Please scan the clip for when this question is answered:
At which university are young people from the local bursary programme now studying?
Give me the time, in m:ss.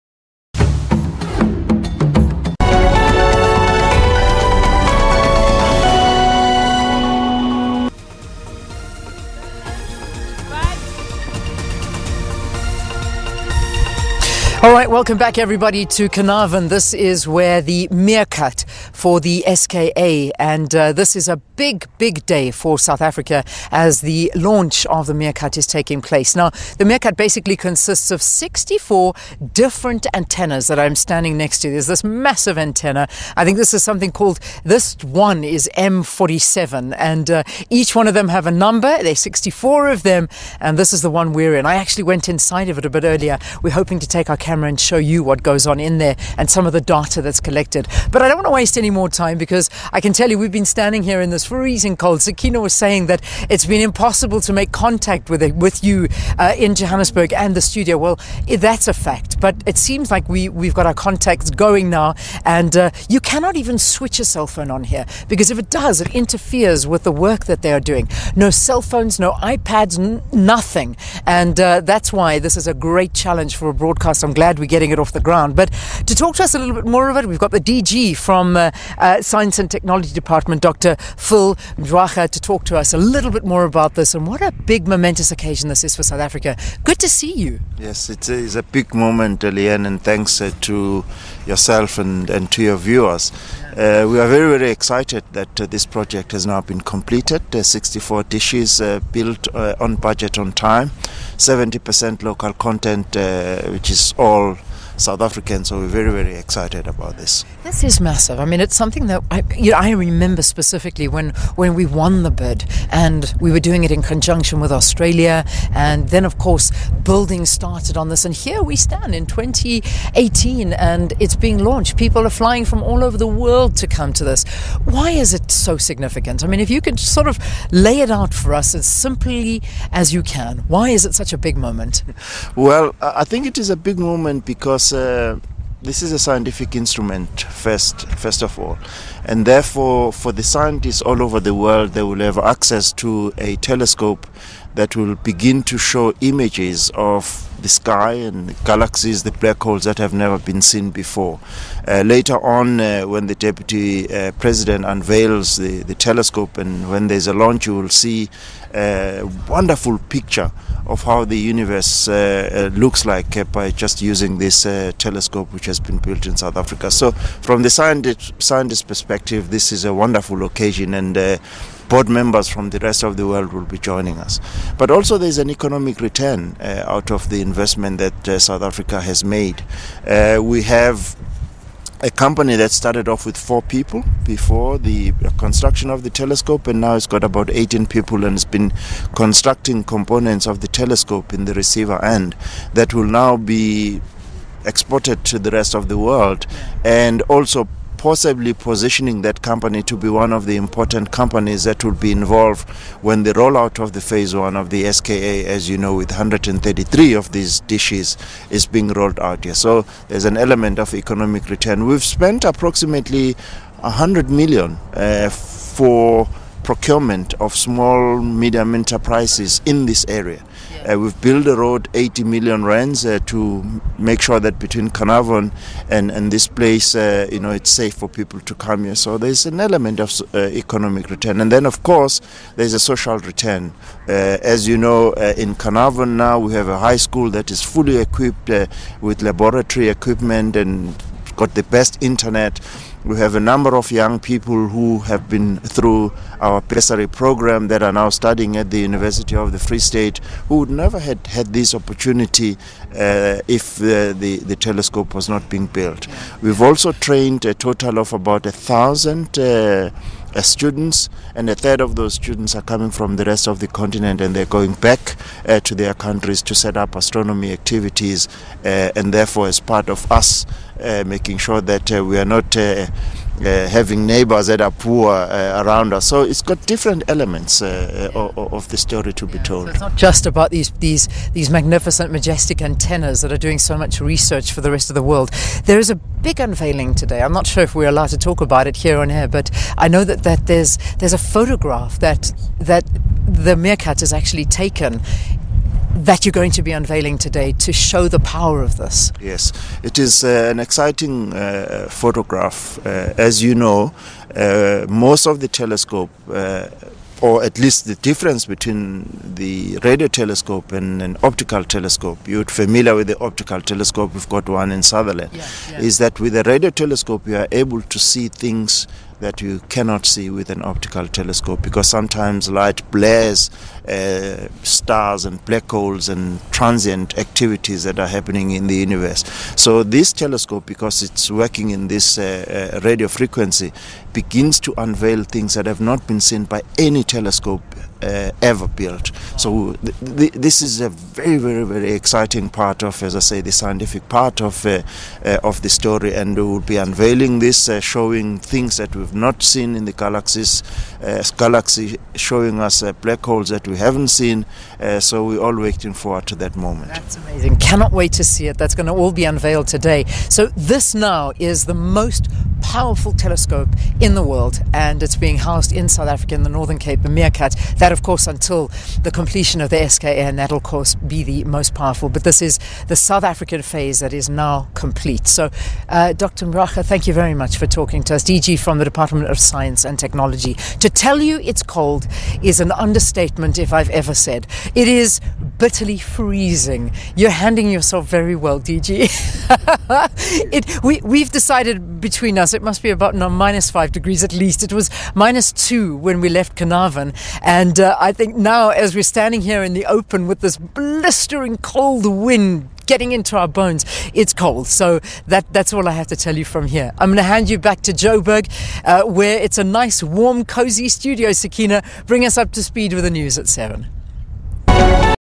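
4:08.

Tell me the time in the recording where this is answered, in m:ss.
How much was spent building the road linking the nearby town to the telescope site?
3:41.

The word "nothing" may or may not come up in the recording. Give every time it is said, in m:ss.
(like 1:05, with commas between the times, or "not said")
1:10.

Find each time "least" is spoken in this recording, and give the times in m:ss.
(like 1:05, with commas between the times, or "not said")
5:07, 6:34.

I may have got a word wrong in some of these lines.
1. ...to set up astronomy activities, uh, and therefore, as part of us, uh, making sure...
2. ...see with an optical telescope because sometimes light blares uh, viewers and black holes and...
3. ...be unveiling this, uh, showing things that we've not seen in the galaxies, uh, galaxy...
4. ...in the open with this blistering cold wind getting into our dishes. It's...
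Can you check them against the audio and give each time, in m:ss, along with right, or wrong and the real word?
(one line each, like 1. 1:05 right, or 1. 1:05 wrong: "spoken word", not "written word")
1. 4:26 right
2. 5:20 wrong: "stars", not "viewers"
3. 5:46 right
4. 6:39 wrong: "bones", not "dishes".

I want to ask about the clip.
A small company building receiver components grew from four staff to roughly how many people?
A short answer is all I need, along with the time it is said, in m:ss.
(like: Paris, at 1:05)
18, at 3:07.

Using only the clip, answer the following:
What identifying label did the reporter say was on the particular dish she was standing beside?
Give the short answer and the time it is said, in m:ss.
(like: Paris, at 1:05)
M47, at 0:35.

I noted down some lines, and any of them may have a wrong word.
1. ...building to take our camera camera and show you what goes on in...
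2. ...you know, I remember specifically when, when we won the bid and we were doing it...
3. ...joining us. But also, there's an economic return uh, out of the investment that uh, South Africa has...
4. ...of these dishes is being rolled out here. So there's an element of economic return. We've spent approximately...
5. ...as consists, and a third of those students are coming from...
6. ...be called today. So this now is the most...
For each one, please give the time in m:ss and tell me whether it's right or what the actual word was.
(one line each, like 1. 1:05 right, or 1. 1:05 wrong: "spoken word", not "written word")
1. 0:43 wrong: "hoping", not "building"
2. 1:49 right
3. 2:53 right
4. 3:27 right
5. 4:20 wrong: "students", not "consists"
6. 5:59 wrong: "unveiled", not "called".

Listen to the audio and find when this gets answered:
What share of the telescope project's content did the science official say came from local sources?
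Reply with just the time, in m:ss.
1:41.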